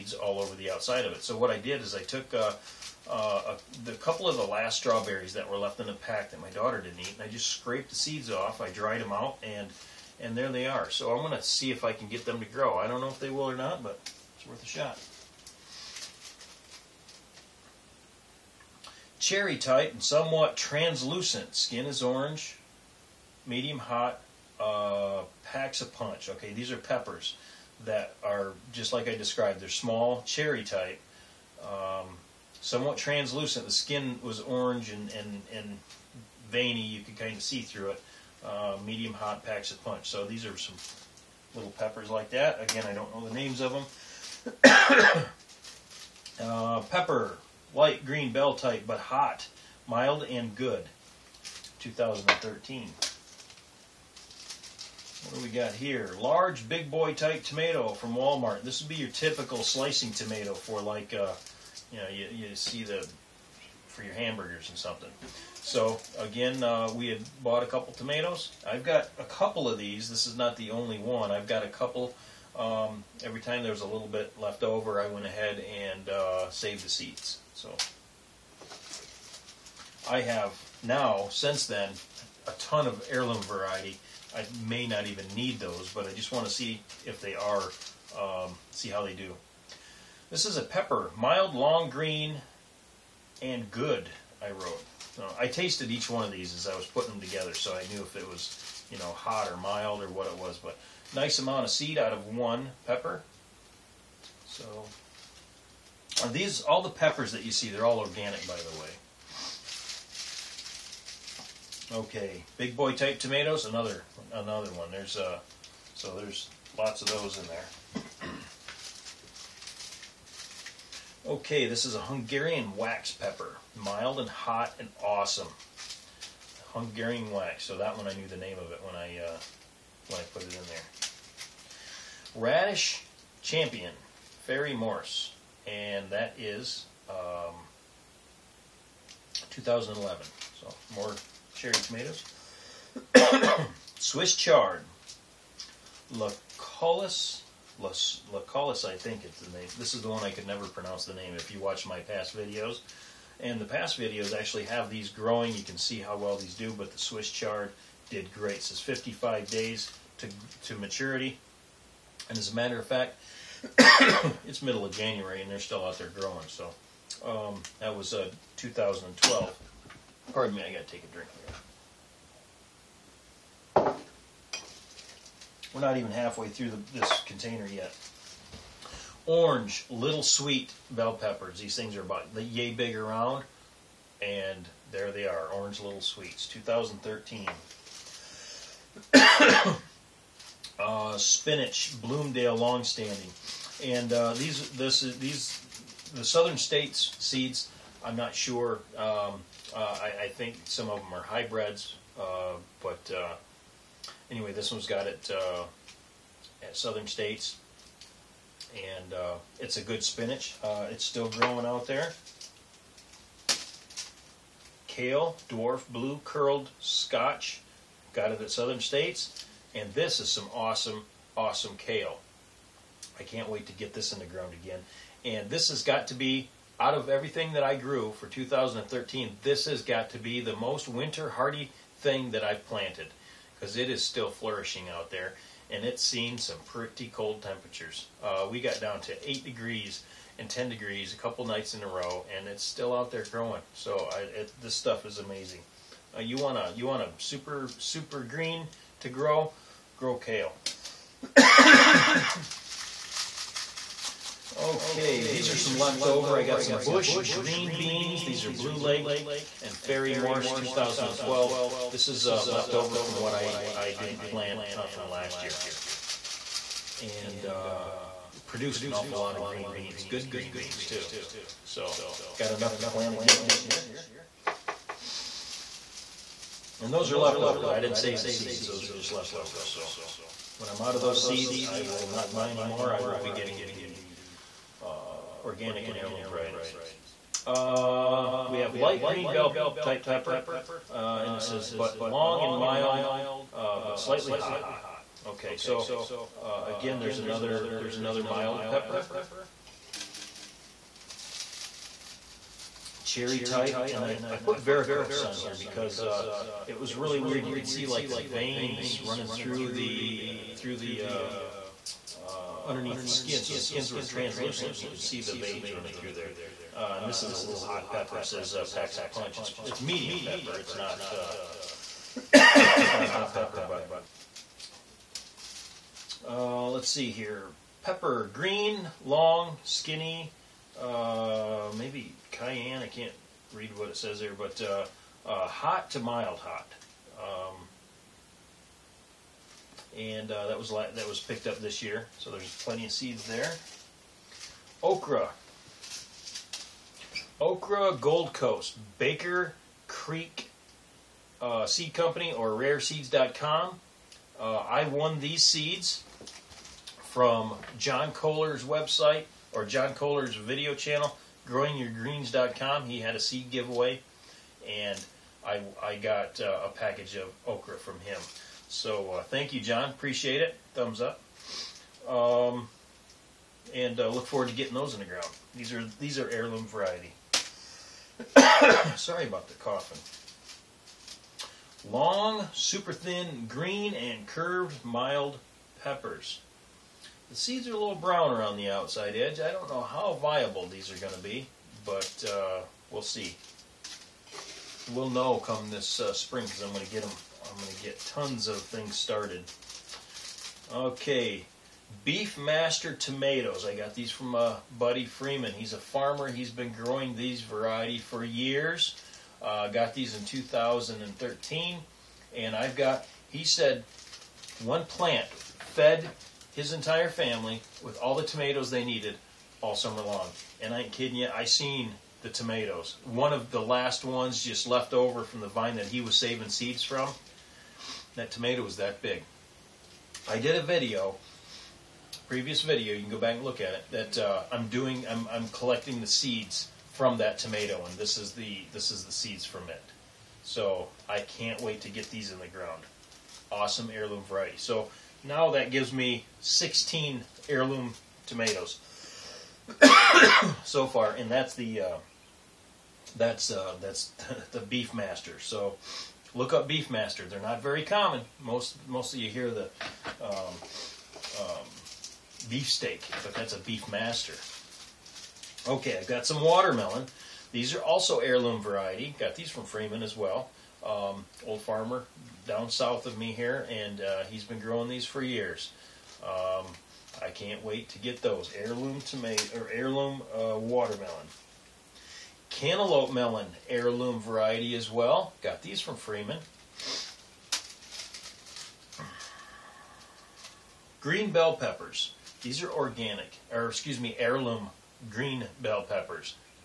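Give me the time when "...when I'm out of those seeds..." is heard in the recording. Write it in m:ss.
4:40.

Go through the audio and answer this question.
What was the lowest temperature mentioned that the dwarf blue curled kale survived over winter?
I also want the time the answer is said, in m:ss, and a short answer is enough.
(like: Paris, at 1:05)
8 degrees, at 3:59.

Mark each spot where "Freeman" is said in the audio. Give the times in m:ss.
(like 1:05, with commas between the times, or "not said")
6:45, 7:49, 8:05.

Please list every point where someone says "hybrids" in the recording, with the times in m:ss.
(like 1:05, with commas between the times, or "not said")
3:21.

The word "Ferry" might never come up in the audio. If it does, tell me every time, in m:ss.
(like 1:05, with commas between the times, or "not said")
2:14, 4:19.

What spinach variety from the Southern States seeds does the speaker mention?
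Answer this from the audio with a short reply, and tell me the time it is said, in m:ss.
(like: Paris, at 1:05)
Bloomdale longstanding, at 3:12.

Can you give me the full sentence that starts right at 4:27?
And uh, produced an awful lot of green beans.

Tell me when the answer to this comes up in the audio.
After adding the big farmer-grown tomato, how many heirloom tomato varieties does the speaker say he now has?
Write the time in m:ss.
7:26.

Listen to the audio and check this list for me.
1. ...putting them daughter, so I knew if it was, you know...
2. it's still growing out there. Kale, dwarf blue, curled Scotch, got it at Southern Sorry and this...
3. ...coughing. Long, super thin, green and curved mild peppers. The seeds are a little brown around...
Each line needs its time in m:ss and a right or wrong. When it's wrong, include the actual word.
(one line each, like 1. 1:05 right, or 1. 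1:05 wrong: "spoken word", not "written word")
1. 1:36 wrong: "together", not "daughter"
2. 3:30 wrong: "States", not "Sorry"
3. 6:19 right.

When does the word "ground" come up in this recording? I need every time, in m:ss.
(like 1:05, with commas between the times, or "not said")
3:44, 6:15, 7:22.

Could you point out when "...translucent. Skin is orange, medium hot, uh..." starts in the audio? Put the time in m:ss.
0:20.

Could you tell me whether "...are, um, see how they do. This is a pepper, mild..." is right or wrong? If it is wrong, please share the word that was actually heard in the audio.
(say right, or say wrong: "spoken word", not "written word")
right.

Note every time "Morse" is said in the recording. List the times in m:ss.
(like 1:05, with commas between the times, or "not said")
2:14, 4:19.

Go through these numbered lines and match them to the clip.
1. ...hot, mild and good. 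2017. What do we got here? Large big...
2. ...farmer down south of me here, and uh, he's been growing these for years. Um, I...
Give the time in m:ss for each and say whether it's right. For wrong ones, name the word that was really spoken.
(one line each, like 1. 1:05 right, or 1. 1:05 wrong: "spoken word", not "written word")
1. 0:48 wrong: "2013", not "2017"
2. 7:51 right.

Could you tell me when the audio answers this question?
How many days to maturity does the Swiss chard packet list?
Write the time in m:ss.
2:38.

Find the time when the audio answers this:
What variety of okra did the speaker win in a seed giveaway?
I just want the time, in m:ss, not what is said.
5:47.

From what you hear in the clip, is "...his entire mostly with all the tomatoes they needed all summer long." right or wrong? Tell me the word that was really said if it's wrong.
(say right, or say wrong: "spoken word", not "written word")
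wrong: "family", not "mostly".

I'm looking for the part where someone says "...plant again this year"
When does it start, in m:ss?
4:32.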